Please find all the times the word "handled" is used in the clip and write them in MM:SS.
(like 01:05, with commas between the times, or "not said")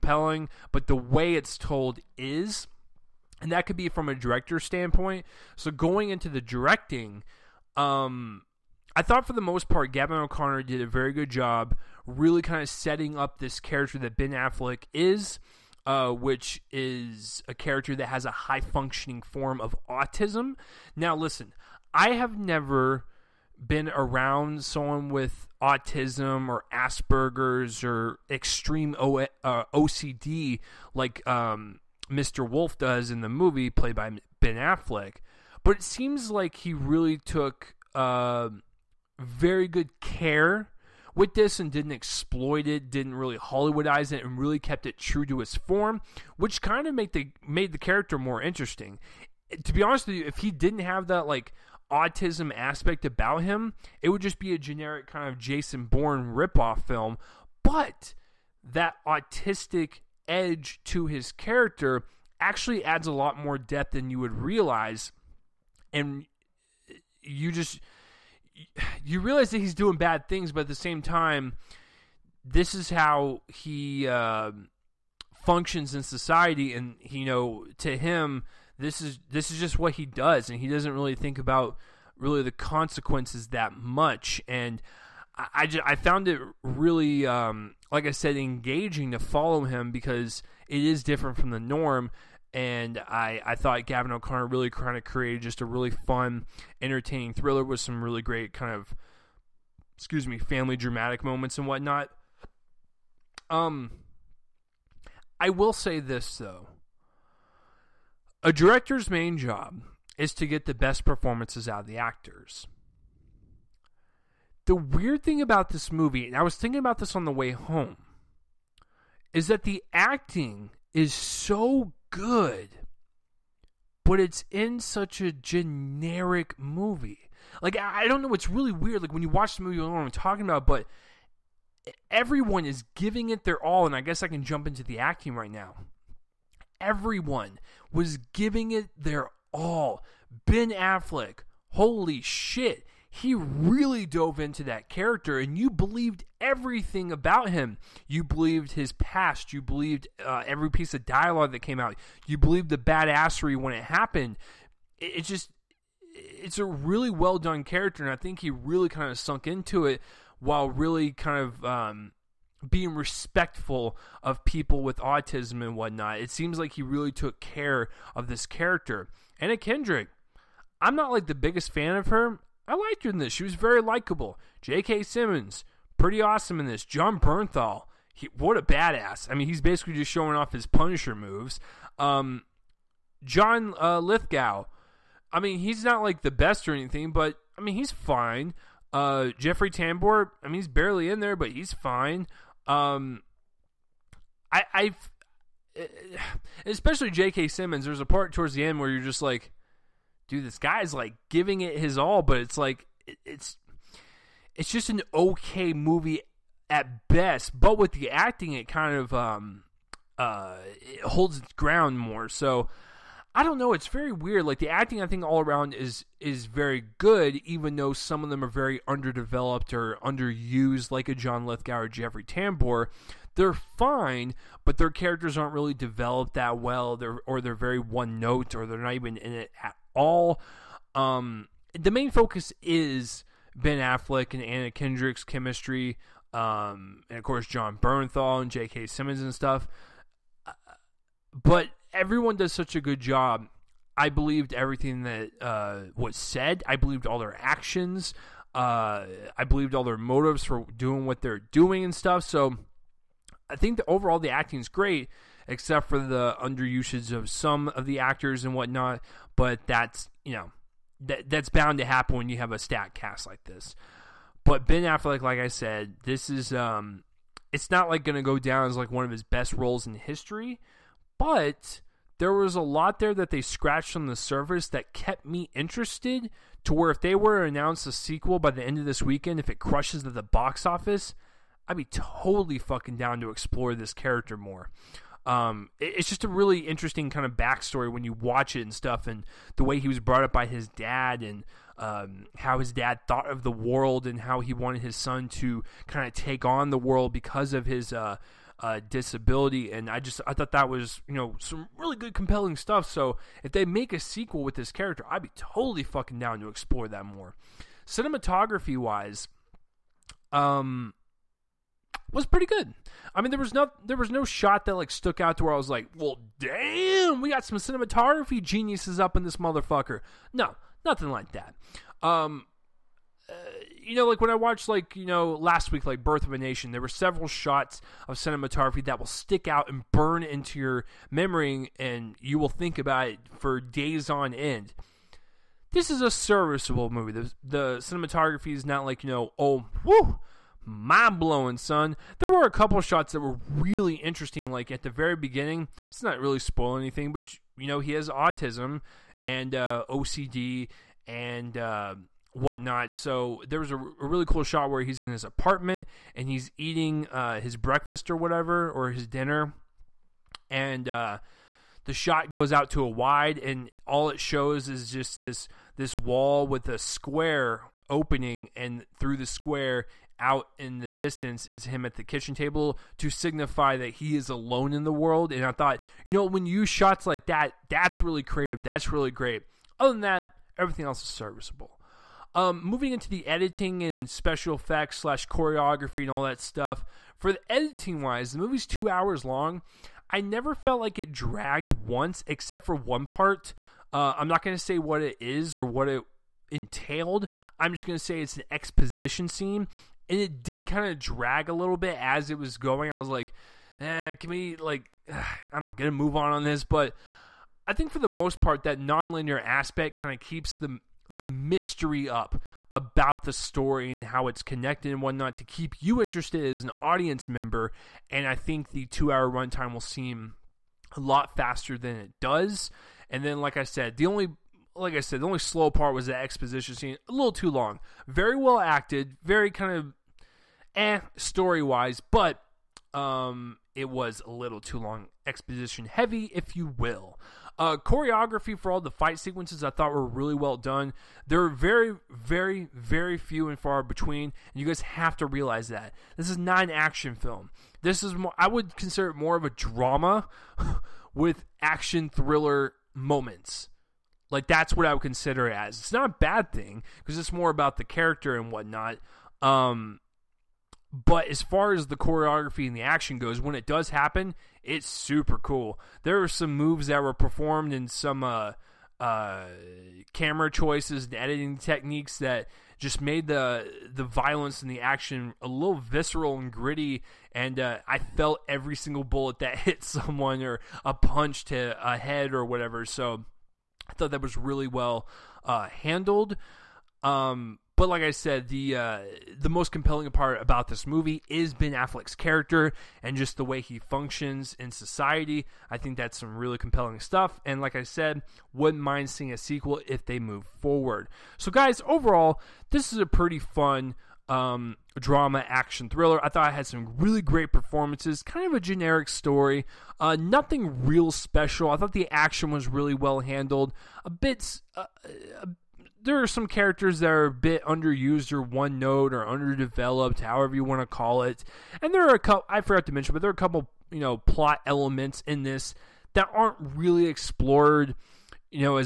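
08:05, 08:33.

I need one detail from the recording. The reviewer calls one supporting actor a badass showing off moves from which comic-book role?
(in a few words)
Punisher.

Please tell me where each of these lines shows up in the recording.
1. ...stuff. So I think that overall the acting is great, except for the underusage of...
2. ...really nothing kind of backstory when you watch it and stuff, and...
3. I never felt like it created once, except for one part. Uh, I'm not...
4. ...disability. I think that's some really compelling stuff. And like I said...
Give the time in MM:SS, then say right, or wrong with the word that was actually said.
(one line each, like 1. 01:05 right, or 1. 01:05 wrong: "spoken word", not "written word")
1. 04:11 right
2. 04:46 wrong: "interesting", not "nothing"
3. 06:30 wrong: "dragged", not "created"
4. 08:14 wrong: "society", not "disability".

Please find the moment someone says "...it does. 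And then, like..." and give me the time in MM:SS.
07:01.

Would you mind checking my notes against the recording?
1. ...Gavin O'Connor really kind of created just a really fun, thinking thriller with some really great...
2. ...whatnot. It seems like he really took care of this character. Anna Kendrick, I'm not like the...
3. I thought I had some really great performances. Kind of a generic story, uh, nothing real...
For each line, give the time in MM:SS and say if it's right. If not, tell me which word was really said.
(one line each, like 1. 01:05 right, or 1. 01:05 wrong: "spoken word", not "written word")
1. 01:33 wrong: "entertaining", not "thinking"
2. 02:45 right
3. 08:26 right.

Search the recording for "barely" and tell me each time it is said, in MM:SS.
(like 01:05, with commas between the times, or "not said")
03:10.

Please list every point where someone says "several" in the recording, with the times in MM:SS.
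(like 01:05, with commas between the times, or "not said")
05:26.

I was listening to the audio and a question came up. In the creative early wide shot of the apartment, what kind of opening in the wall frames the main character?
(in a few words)
Square opening.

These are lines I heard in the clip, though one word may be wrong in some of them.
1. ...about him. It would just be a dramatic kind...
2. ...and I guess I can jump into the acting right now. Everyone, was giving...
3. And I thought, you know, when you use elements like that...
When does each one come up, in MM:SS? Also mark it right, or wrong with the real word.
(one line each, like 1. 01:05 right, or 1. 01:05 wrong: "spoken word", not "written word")
1. 00:53 wrong: "generic", not "dramatic"
2. 02:13 right
3. 06:15 wrong: "shots", not "elements".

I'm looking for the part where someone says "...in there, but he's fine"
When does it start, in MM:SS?
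03:11.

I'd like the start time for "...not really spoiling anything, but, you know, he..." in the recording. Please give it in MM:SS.
05:46.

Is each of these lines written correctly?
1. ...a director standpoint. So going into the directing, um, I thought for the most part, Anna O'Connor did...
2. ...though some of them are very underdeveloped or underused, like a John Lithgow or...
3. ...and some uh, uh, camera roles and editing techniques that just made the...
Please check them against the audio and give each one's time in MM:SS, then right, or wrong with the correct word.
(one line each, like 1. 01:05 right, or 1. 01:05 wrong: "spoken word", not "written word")
1. 00:04 wrong: "Gavin", not "Anna"
2. 03:37 right
3. 07:47 wrong: "choices", not "roles".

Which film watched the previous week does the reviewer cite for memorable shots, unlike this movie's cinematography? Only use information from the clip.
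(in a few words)
Birth of a Nation.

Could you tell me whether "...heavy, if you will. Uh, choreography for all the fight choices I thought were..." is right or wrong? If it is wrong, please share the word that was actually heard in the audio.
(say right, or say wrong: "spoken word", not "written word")
wrong: "sequences", not "choices".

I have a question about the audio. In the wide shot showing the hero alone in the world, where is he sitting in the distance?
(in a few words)
Kitchen table.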